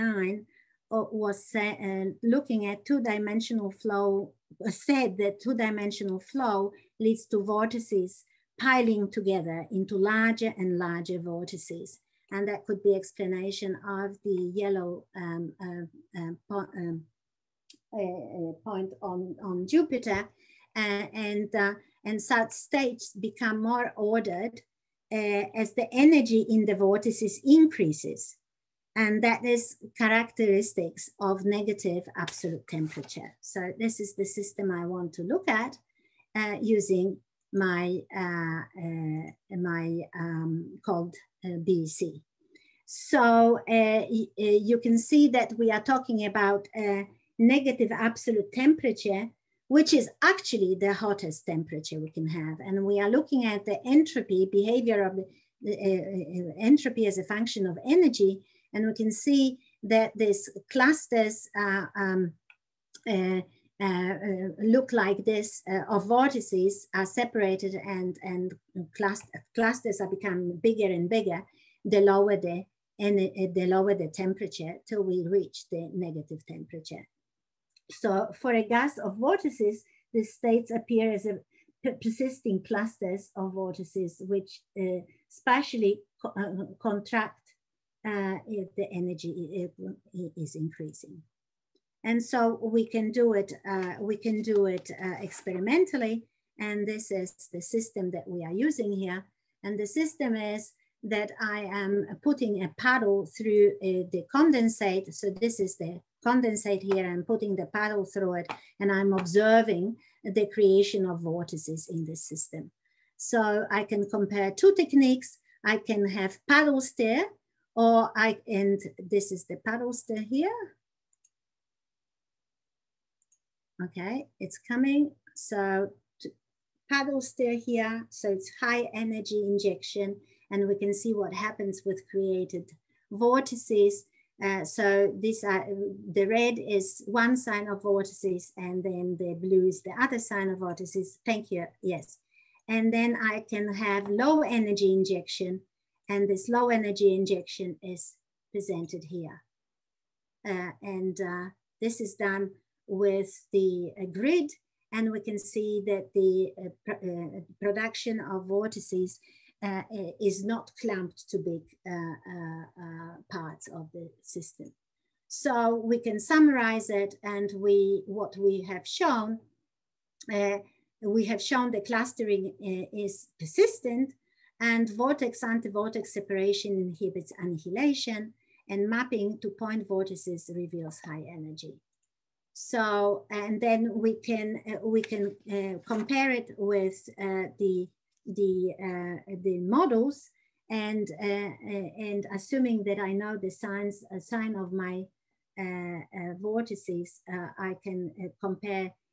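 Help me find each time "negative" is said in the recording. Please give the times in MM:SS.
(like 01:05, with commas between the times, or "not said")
00:31, 00:47, 01:15.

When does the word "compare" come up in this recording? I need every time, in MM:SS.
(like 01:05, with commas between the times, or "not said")
01:54, 03:05, 03:18.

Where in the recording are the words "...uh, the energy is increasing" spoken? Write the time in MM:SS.
01:28.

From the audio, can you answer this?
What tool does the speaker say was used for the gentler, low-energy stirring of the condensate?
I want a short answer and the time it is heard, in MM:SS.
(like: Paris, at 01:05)
grid, at 02:34.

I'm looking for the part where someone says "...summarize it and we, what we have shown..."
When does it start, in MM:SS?
02:46.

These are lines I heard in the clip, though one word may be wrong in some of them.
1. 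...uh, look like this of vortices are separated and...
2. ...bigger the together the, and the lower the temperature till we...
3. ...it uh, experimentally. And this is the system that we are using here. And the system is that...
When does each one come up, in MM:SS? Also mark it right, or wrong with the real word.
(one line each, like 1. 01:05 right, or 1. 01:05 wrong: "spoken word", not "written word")
1. 01:03 right
2. 01:11 wrong: "lower", not "together"
3. 01:34 right.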